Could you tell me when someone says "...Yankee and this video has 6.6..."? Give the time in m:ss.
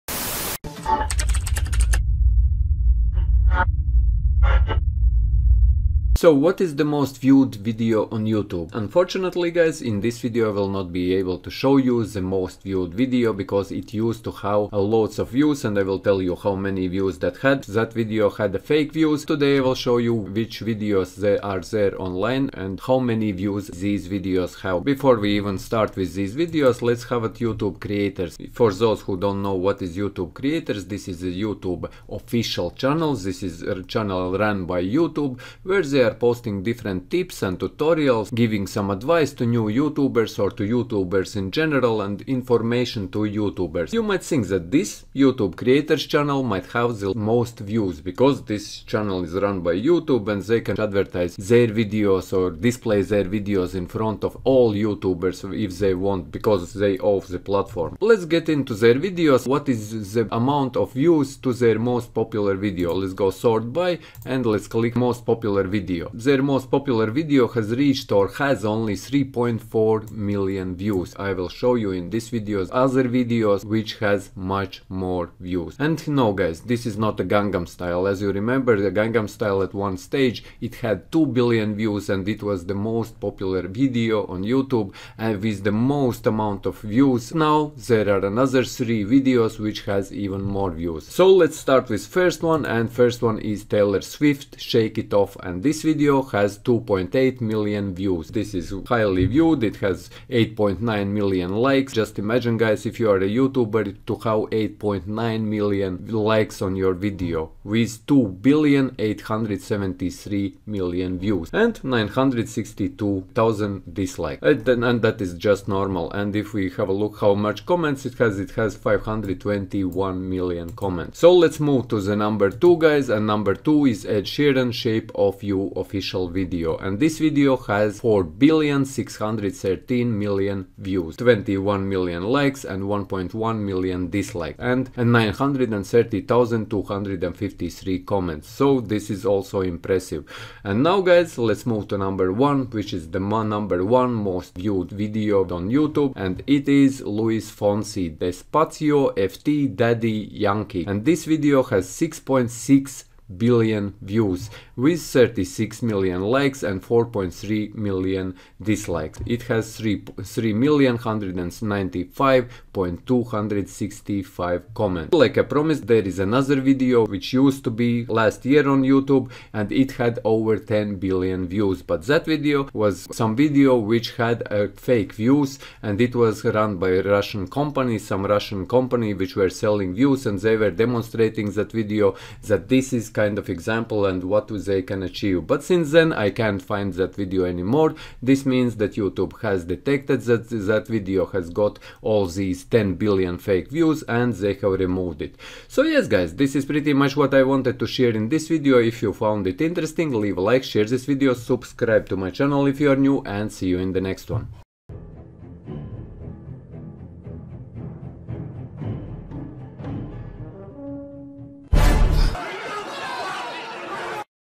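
2:30.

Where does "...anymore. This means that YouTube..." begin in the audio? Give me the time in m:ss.
3:07.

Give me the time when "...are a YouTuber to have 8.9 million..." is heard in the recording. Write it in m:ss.
1:43.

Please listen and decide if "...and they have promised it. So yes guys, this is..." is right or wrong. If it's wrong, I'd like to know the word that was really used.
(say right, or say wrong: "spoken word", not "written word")
wrong: "removed", not "promised".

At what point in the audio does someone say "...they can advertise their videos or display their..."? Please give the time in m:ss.
0:50.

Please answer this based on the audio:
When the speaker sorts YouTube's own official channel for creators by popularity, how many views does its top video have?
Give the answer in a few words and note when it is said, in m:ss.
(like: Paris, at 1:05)
3.4 million, at 1:08.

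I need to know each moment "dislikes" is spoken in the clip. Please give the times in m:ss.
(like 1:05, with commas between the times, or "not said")
1:54, 2:14, 2:38.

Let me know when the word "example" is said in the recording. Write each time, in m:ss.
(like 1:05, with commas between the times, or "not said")
3:03.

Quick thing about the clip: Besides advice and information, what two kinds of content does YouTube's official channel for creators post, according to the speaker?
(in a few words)
tips and tutorials.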